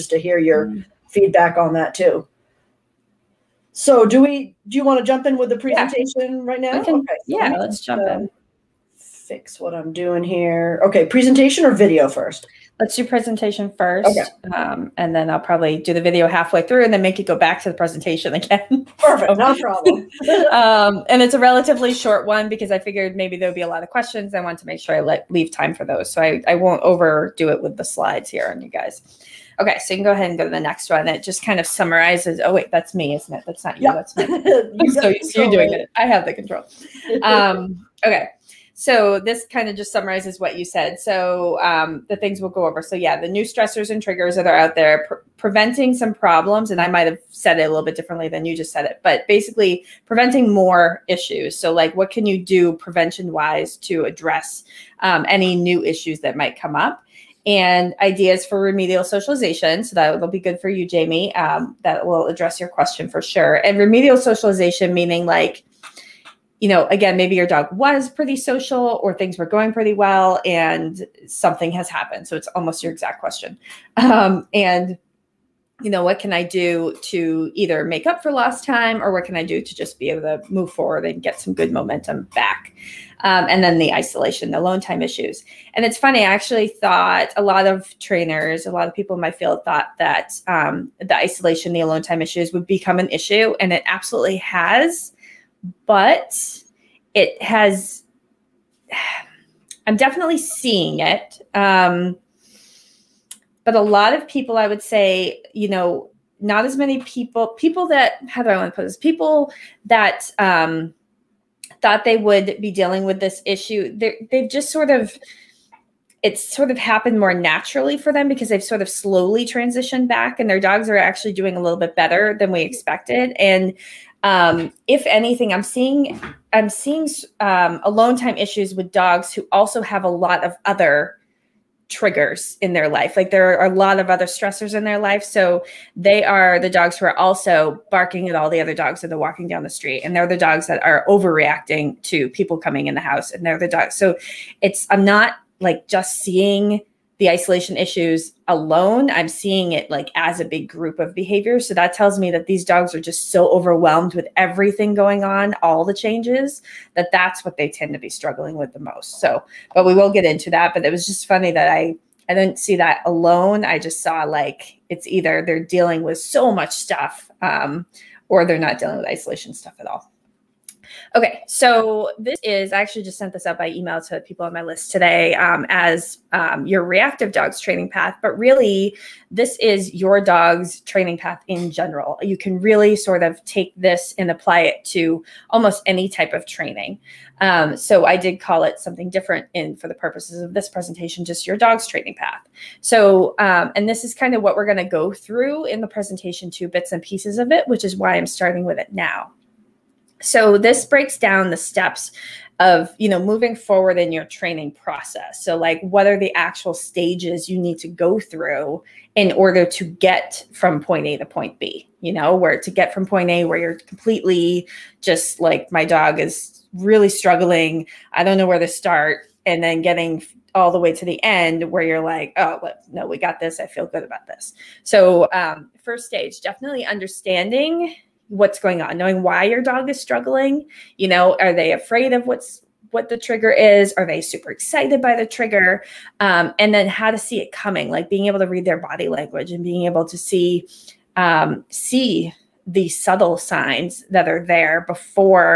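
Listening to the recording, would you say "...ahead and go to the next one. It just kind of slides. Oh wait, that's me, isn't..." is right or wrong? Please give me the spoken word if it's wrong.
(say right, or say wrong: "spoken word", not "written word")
wrong: "summarizes", not "slides".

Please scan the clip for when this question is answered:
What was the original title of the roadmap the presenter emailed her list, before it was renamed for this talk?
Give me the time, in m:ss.
2:56.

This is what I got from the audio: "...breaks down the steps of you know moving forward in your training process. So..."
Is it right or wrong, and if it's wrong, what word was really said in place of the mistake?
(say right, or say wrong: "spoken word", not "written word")
right.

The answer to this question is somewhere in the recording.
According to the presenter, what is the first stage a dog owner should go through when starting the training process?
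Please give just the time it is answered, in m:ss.
3:46.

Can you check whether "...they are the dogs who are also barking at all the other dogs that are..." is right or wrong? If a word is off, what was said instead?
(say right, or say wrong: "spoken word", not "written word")
right.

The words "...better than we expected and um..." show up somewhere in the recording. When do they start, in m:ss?
2:01.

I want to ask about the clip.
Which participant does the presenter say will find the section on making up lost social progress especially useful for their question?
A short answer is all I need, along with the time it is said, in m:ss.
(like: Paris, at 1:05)
Jamie, at 1:00.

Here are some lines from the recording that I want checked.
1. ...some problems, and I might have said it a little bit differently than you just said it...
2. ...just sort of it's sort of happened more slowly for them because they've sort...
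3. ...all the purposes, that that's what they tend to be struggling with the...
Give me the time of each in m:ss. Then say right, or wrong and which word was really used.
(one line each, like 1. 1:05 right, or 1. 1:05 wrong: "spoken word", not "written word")
1. 0:45 right
2. 1:54 wrong: "naturally", not "slowly"
3. 2:35 wrong: "changes", not "purposes".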